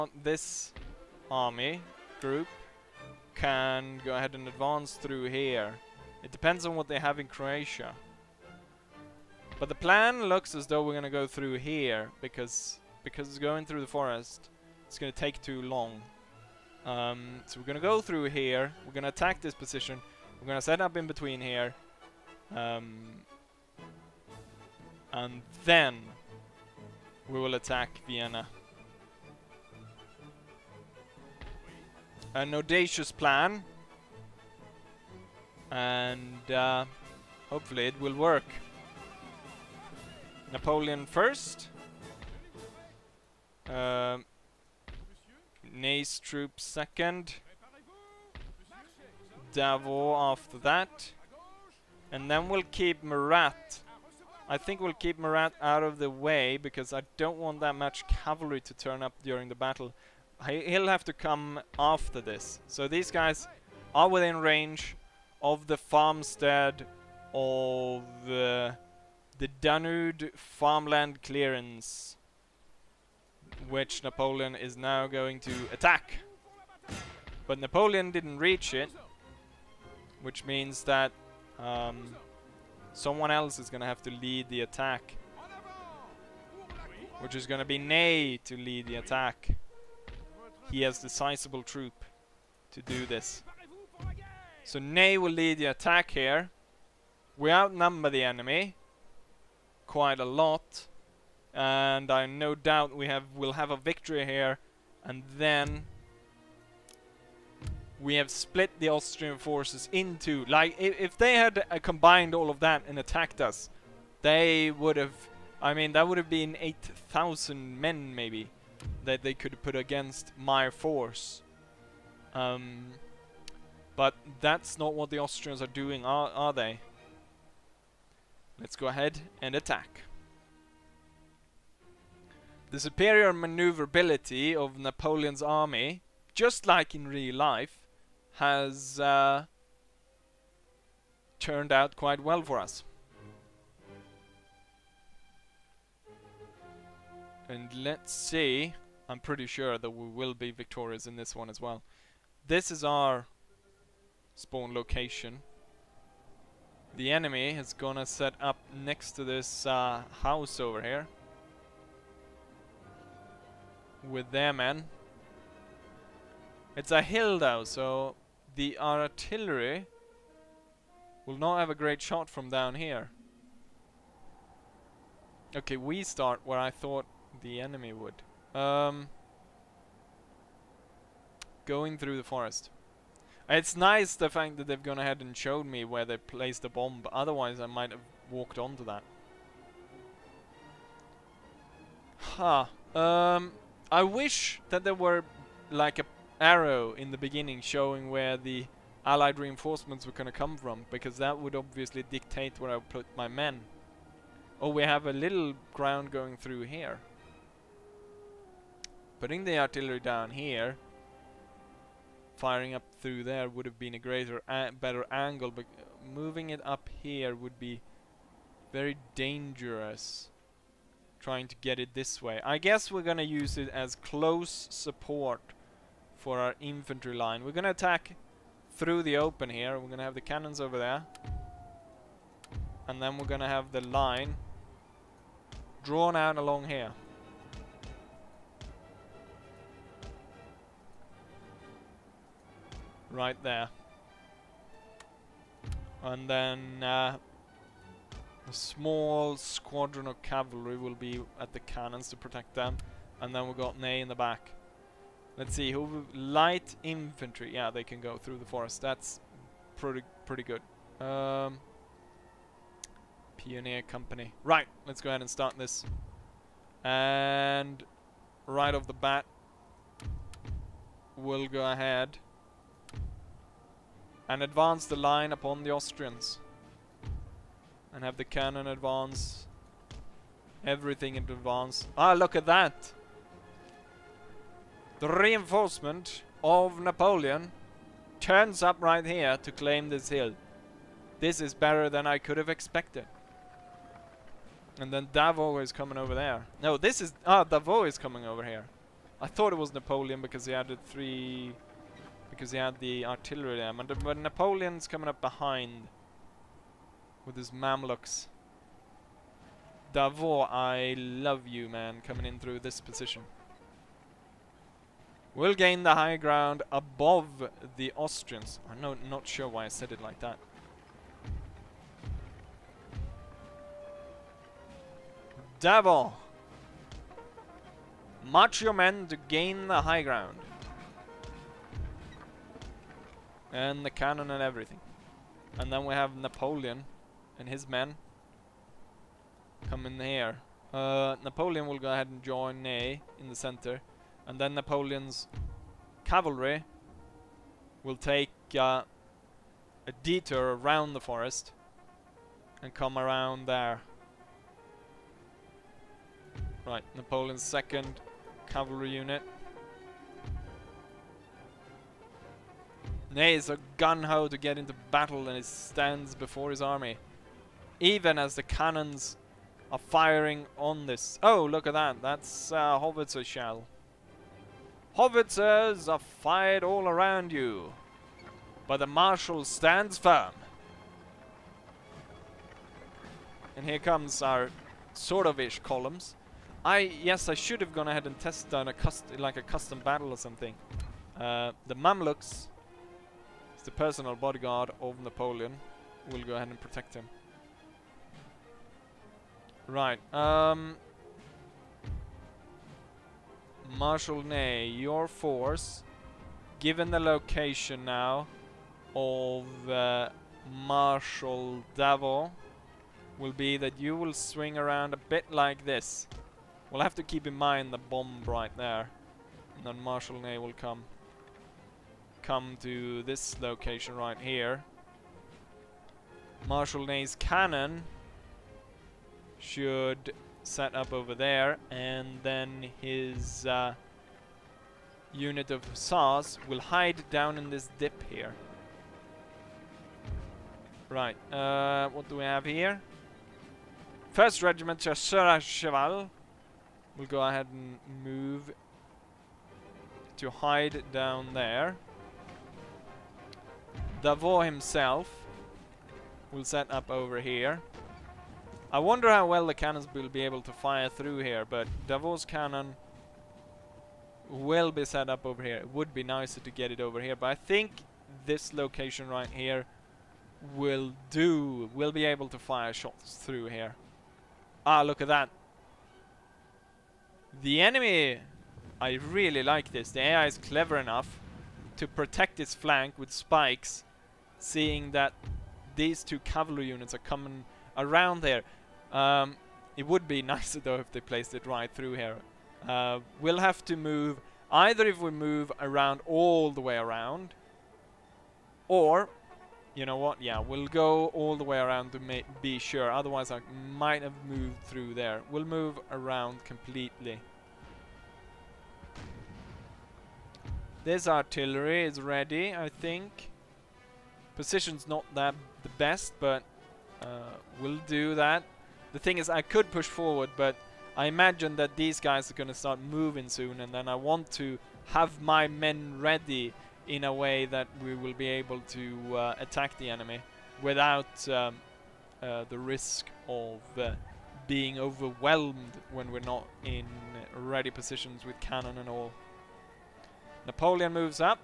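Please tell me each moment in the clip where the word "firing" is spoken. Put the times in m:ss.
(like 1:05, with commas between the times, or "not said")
3:32, 6:09.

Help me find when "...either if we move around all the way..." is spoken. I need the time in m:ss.
8:14.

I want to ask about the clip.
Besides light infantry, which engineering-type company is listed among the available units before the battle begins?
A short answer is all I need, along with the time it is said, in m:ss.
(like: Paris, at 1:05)
Pioneer Company, at 4:23.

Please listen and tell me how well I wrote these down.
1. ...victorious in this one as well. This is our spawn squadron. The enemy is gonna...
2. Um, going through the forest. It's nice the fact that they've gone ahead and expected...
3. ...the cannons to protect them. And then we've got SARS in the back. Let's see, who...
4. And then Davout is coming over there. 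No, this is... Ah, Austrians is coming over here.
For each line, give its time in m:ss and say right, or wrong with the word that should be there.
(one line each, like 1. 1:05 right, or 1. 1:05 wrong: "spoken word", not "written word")
1. 2:30 wrong: "location", not "squadron"
2. 2:58 wrong: "showed", not "expected"
3. 4:11 wrong: "Ney", not "SARS"
4. 4:54 wrong: "Davout", not "Austrians".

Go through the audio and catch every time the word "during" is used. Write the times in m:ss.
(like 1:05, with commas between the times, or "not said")
0:59.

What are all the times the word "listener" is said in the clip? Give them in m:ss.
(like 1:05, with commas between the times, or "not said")
not said.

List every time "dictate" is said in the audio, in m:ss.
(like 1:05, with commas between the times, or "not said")
3:22.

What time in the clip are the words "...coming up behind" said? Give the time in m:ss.
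5:04.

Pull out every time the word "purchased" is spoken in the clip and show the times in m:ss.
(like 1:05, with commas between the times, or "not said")
not said.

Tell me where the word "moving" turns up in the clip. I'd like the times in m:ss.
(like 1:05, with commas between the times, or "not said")
3:36, 8:42.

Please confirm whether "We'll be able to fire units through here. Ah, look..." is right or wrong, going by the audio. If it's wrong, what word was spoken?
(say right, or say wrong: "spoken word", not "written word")
wrong: "shots", not "units".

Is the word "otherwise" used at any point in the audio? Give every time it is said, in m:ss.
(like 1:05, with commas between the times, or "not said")
3:07, 8:22.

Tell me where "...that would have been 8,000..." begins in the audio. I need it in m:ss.
1:55.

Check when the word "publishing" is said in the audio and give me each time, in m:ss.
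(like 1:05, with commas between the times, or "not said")
not said.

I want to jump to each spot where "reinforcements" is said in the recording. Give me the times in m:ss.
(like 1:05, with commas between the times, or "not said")
3:19, 4:45.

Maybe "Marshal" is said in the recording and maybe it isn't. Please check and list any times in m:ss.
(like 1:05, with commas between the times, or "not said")
6:18, 6:43, 6:50, 6:59, 7:06.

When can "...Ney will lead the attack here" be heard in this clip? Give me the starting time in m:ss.
1:34.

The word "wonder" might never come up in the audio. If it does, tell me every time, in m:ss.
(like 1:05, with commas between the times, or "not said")
7:38.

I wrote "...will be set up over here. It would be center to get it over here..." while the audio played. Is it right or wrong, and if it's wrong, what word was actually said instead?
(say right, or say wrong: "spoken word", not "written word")
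wrong: "nicer", not "center".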